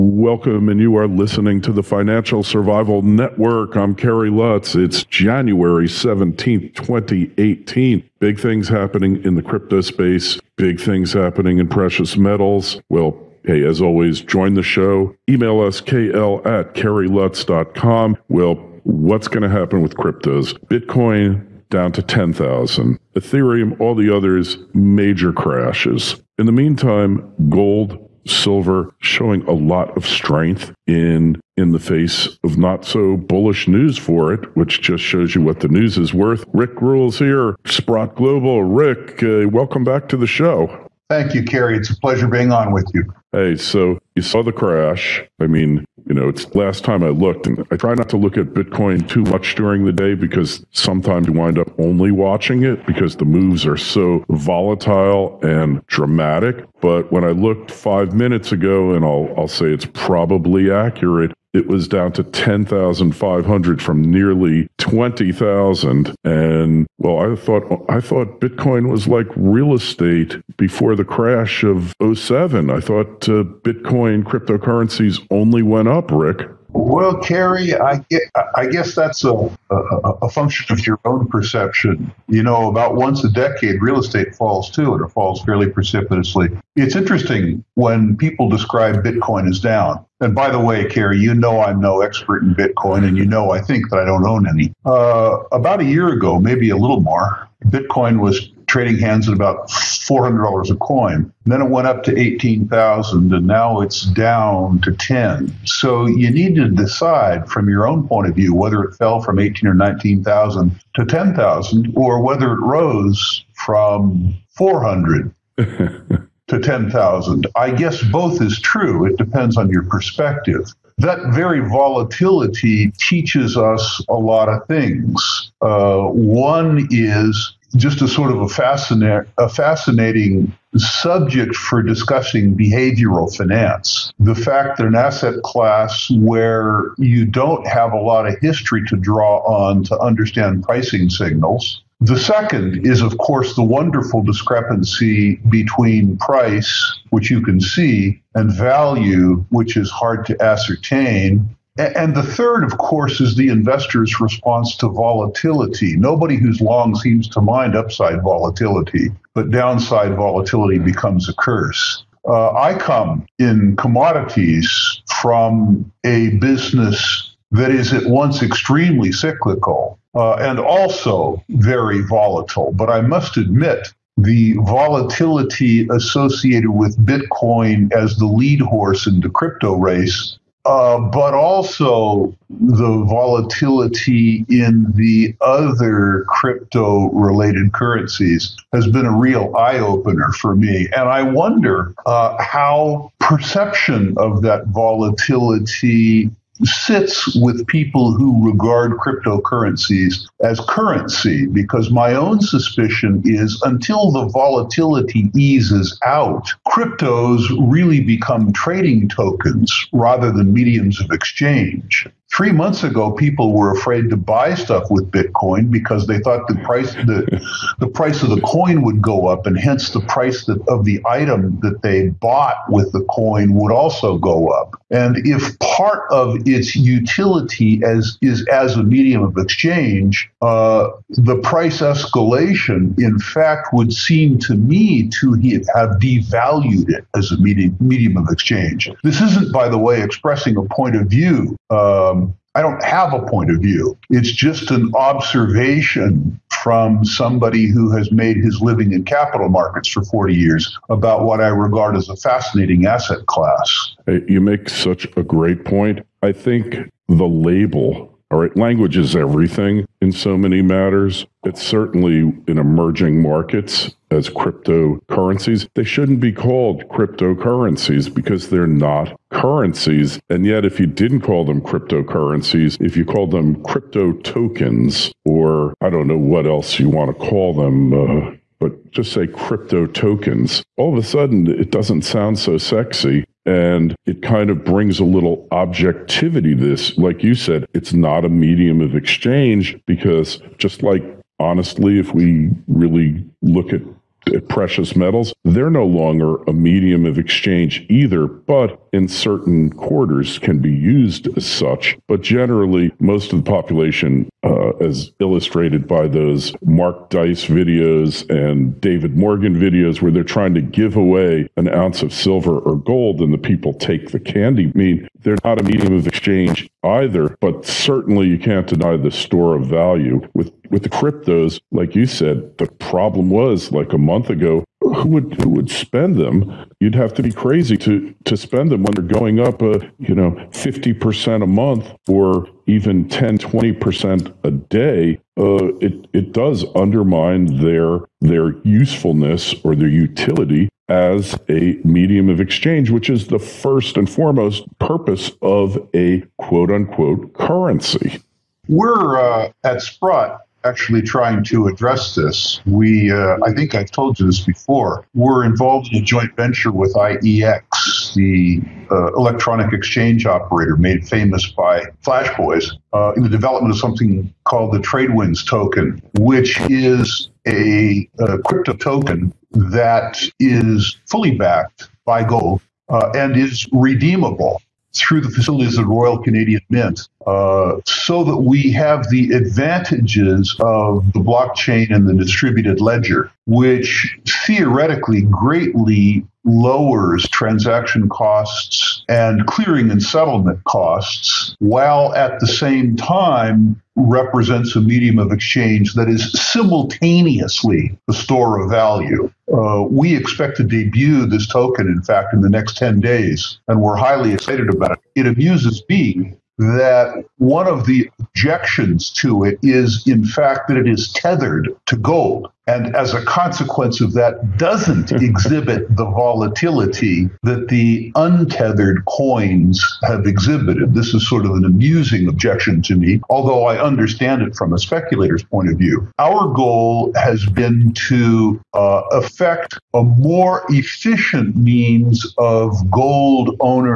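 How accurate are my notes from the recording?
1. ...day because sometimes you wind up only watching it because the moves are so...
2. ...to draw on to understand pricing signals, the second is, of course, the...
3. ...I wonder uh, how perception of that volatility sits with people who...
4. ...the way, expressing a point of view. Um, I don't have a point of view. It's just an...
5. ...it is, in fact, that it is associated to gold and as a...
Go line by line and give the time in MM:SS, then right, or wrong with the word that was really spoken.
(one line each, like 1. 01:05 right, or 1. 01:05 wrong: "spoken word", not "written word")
1. 00:49 right
2. 02:18 right
3. 03:11 right
4. 03:59 right
5. 06:49 wrong: "tethered", not "associated".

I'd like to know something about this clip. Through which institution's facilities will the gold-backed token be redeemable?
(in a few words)
Royal Canadian Mint.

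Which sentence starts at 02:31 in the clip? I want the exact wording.
And the third, of course, is the investor's response to volatility.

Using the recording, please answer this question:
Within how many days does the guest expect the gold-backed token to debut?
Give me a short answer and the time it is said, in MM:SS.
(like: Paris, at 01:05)
10, at 06:42.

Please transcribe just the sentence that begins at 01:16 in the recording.
Well, Kerry, I, I guess that's a, a, a, function of your own perception.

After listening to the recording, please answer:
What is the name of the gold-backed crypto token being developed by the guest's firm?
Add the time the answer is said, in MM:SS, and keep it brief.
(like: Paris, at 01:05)
TradeWinds token, at 06:04.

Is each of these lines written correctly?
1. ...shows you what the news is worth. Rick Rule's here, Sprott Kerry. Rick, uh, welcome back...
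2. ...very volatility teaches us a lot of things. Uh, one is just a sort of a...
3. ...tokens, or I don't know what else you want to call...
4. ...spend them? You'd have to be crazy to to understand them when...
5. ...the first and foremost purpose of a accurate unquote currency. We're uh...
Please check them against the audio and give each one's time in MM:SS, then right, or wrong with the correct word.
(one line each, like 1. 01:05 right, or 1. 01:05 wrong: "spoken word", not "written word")
1. 00:35 wrong: "Global", not "Kerry"
2. 02:01 right
3. 04:34 right
4. 05:25 wrong: "spend", not "understand"
5. 05:43 wrong: "quote", not "accurate".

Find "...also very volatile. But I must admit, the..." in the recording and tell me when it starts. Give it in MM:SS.
02:50.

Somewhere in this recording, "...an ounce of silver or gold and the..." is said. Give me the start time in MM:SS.
05:11.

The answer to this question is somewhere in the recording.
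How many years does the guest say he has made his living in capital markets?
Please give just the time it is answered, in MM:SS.
04:10.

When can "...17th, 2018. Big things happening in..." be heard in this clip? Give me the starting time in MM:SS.
00:05.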